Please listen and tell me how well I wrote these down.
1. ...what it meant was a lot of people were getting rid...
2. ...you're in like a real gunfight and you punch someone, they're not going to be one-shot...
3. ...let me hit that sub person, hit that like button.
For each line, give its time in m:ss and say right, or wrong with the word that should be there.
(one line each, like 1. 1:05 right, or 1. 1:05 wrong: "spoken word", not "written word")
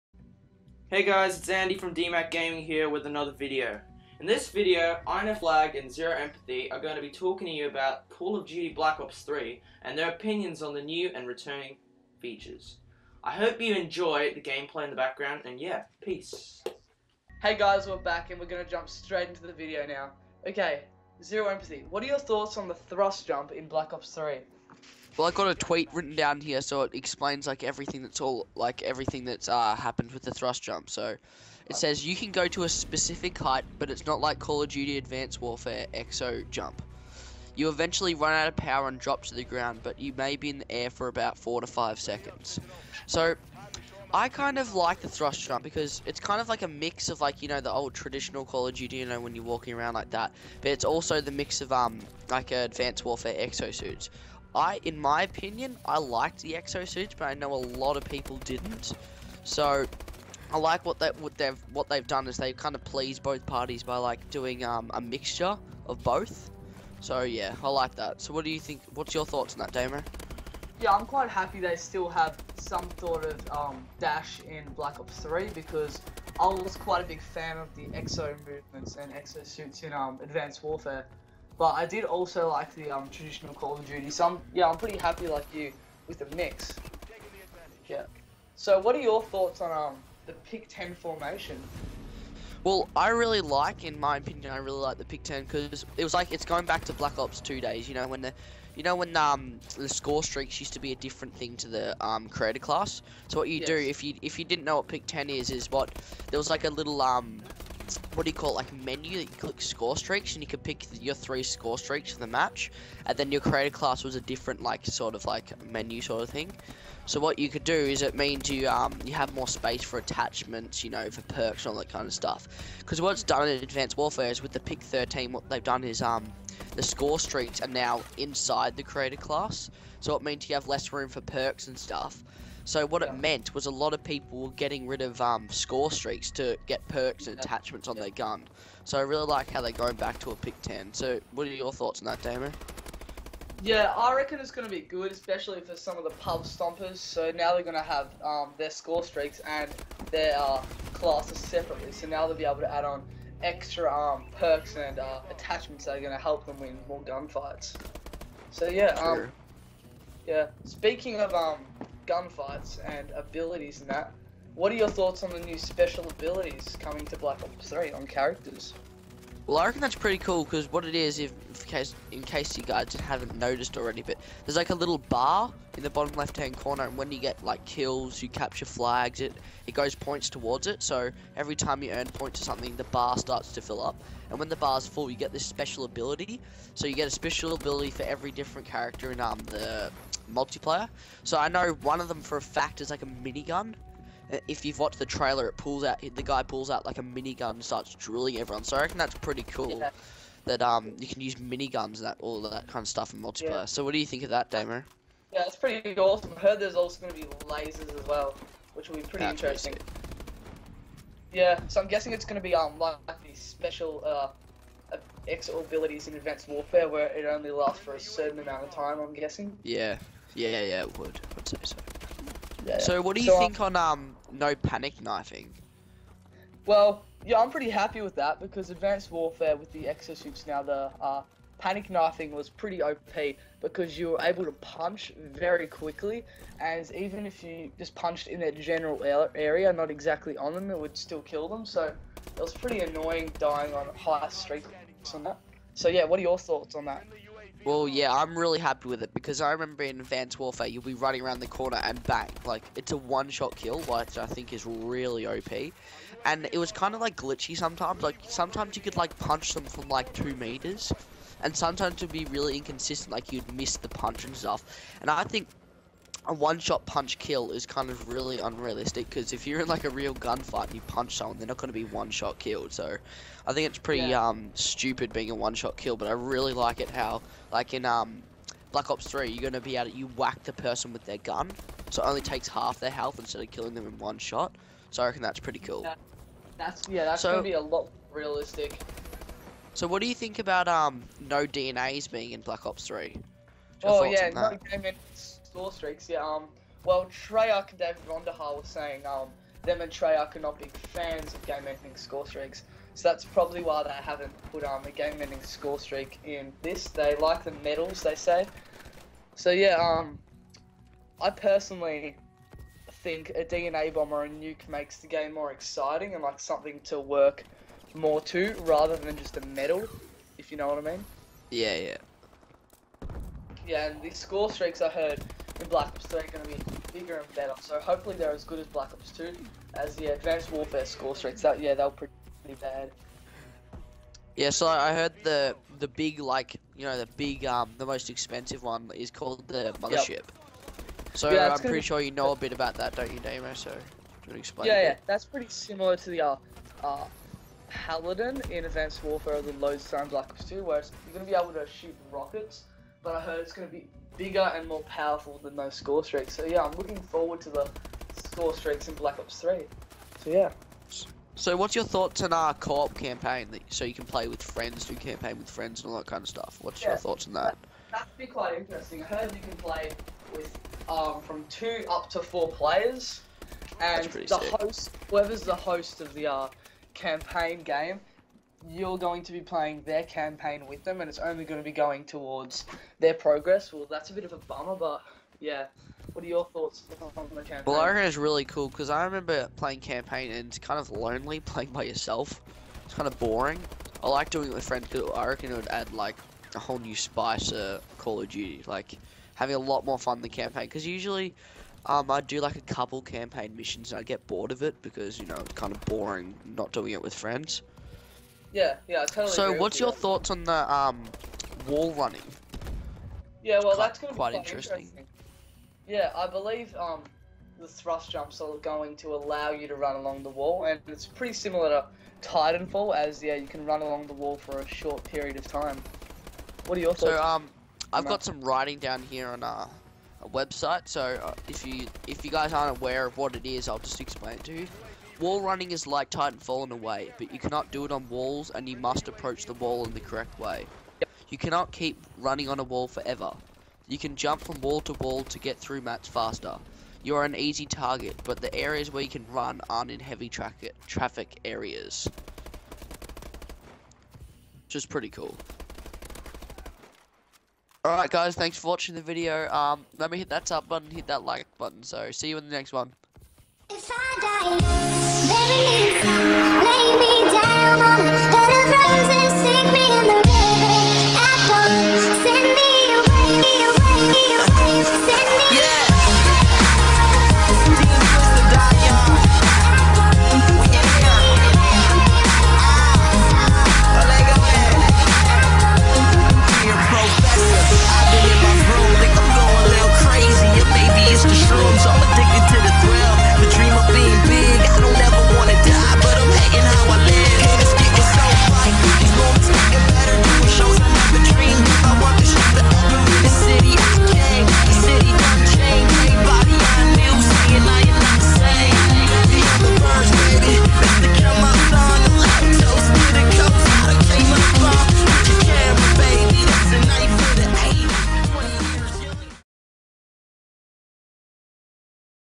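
1. 2:12 right
2. 4:29 right
3. 7:39 wrong: "button", not "person".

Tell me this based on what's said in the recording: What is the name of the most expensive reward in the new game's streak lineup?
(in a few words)
the mothership.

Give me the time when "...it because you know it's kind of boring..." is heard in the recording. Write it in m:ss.
6:44.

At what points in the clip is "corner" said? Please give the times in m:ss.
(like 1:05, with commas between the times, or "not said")
2:56, 4:11.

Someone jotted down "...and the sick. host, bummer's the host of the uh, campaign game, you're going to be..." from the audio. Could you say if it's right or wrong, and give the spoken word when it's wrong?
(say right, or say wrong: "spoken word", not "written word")
wrong: "whoever", not "bummer".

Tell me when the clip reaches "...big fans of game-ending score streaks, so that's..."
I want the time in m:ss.
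5:00.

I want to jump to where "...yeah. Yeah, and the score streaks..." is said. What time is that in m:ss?
5:21.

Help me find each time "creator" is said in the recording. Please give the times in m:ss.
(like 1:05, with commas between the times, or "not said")
1:42, 1:53, 2:08.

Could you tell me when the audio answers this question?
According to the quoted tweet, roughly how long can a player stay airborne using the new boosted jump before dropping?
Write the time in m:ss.
0:41.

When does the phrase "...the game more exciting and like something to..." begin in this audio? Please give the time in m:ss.
5:14.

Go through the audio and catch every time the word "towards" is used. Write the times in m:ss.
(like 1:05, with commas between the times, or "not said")
3:00, 6:22.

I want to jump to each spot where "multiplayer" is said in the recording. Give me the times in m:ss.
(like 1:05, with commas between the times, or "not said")
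3:10, 3:23.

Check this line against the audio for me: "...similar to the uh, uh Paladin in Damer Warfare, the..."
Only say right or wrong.
wrong.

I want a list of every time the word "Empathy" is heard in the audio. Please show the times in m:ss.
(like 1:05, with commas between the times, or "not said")
0:06, 0:21.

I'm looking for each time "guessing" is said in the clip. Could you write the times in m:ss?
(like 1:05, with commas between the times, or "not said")
3:31, 3:39.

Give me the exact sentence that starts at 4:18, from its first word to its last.
Like sometimes you could like punch them from like two meters, and sometimes it'd be really inconsistent.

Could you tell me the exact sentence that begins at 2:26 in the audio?
So now they're going to have um, their score streaks and their uh, classes separately.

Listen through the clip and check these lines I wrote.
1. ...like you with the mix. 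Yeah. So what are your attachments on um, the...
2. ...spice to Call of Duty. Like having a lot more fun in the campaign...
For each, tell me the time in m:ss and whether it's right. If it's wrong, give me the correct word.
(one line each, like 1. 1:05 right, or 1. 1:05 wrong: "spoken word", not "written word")
1. 1:25 wrong: "thoughts", not "attachments"
2. 6:36 right.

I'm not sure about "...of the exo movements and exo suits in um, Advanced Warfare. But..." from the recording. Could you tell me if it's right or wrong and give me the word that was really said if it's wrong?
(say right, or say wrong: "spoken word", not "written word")
right.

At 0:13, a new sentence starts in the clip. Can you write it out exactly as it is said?
I hope you enjoy the gameplay in the background, and yeah, peace.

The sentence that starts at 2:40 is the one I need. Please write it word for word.
Speaking of um, gunfights and abilities and that.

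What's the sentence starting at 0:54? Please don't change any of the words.
I, in my opinion, I liked the suits, but I know a lot of people didn't.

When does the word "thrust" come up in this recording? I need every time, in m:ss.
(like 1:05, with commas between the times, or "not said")
0:22, 0:30, 0:45, 6:57.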